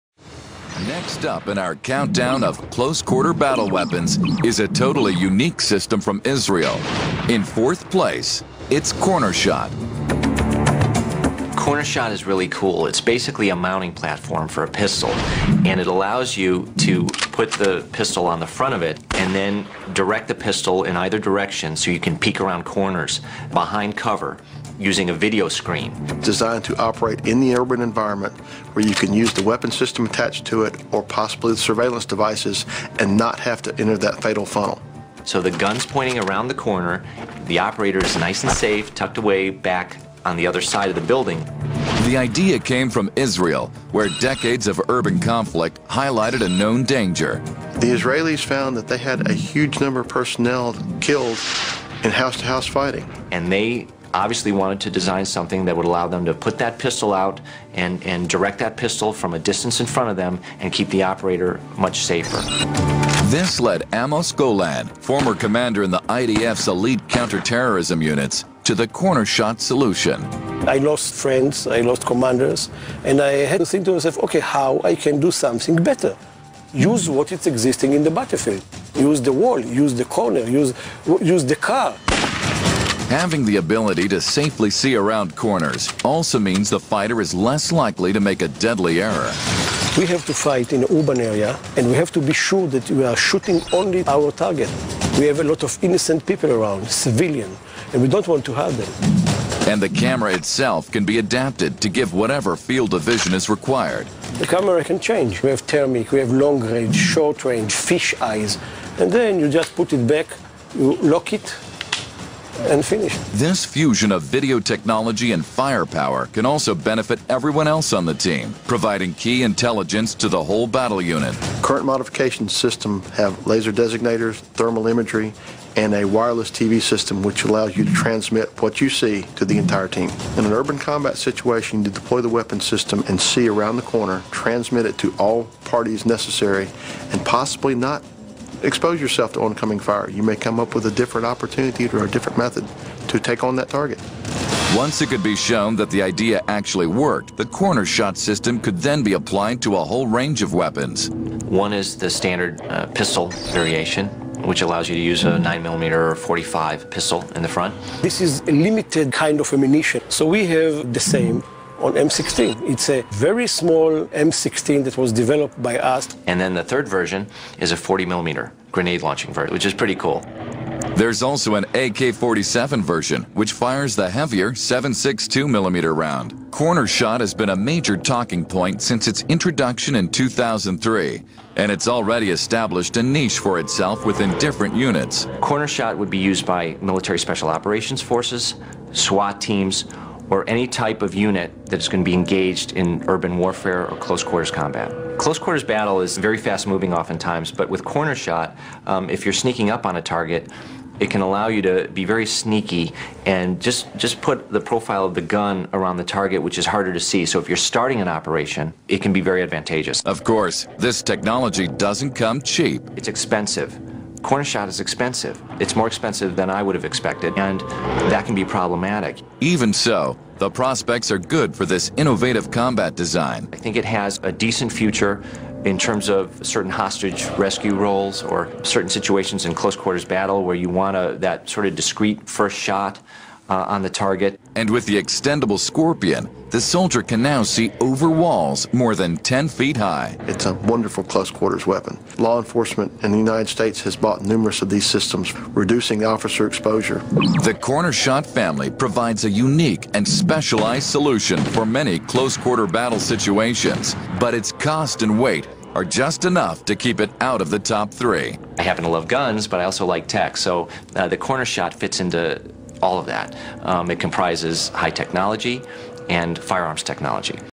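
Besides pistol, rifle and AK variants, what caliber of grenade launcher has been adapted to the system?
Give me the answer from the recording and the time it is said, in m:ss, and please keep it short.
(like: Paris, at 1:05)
40 millimeter, at 2:47.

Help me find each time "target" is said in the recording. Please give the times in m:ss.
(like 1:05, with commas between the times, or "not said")
1:34, 2:23, 3:20, 3:26, 3:53.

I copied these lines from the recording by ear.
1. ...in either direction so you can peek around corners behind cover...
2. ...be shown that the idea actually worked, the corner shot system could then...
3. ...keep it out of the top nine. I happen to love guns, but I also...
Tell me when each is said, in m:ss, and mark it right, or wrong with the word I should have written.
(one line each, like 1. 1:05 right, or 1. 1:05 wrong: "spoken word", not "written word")
1. 0:20 right
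2. 2:25 right
3. 4:16 wrong: "three", not "nine".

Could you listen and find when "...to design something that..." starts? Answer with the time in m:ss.
0:54.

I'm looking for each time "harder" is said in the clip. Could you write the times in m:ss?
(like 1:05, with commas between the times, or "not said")
3:26.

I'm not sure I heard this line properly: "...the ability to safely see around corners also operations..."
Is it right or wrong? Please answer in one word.
wrong.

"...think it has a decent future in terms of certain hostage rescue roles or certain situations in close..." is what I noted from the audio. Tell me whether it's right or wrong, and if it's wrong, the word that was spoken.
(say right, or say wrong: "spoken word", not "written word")
right.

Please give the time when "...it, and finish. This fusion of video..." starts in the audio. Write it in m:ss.
1:51.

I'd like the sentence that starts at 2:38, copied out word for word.
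This is a limited kind of ammunition.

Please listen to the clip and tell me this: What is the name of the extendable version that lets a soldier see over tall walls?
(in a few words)
Scorpion.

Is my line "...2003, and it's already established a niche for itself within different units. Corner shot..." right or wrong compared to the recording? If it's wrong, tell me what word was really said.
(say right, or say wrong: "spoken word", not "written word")
right.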